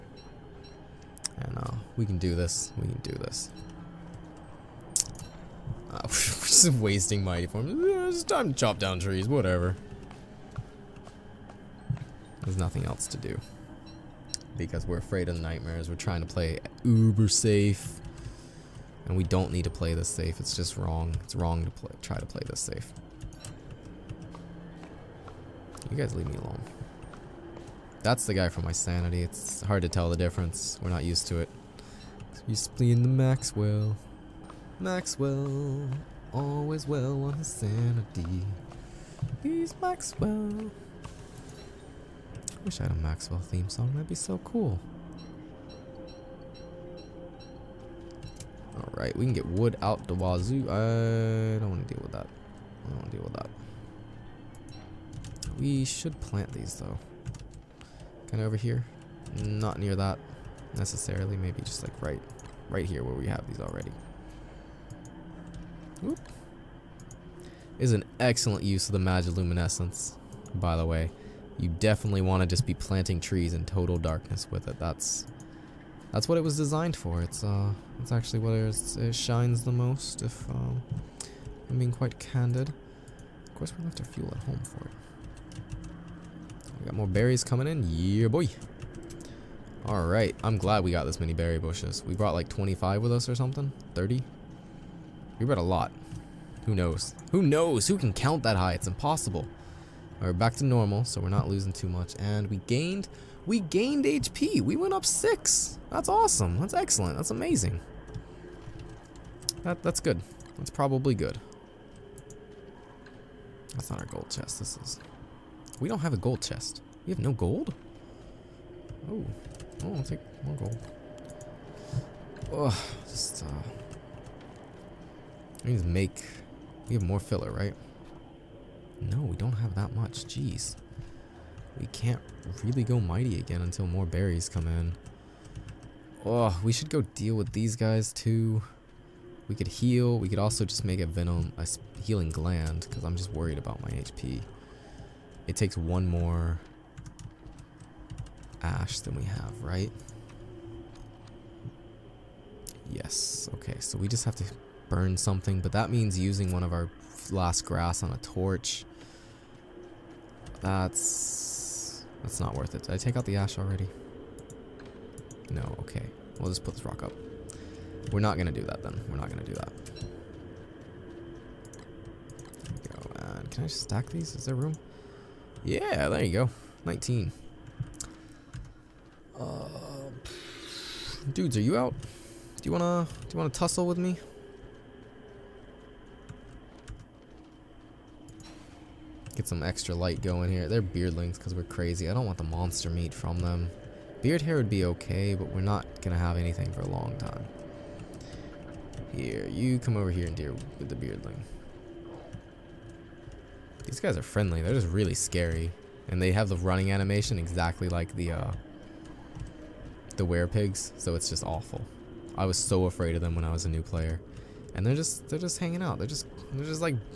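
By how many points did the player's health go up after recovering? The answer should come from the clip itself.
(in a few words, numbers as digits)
6.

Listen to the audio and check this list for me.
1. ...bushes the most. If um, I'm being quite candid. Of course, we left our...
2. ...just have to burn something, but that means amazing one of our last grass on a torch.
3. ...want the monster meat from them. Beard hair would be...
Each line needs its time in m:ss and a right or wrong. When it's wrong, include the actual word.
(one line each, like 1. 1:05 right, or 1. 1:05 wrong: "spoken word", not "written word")
1. 1:19 wrong: "shines", not "bushes"
2. 2:34 wrong: "using", not "amazing"
3. 3:12 right.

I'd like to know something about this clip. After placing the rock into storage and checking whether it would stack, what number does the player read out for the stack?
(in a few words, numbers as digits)
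19.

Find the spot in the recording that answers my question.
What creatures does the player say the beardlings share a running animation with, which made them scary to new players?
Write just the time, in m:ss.
3:30.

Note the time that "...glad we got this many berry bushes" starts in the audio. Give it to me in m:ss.
1:30.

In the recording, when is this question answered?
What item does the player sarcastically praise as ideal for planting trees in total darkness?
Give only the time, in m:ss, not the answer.
1:08.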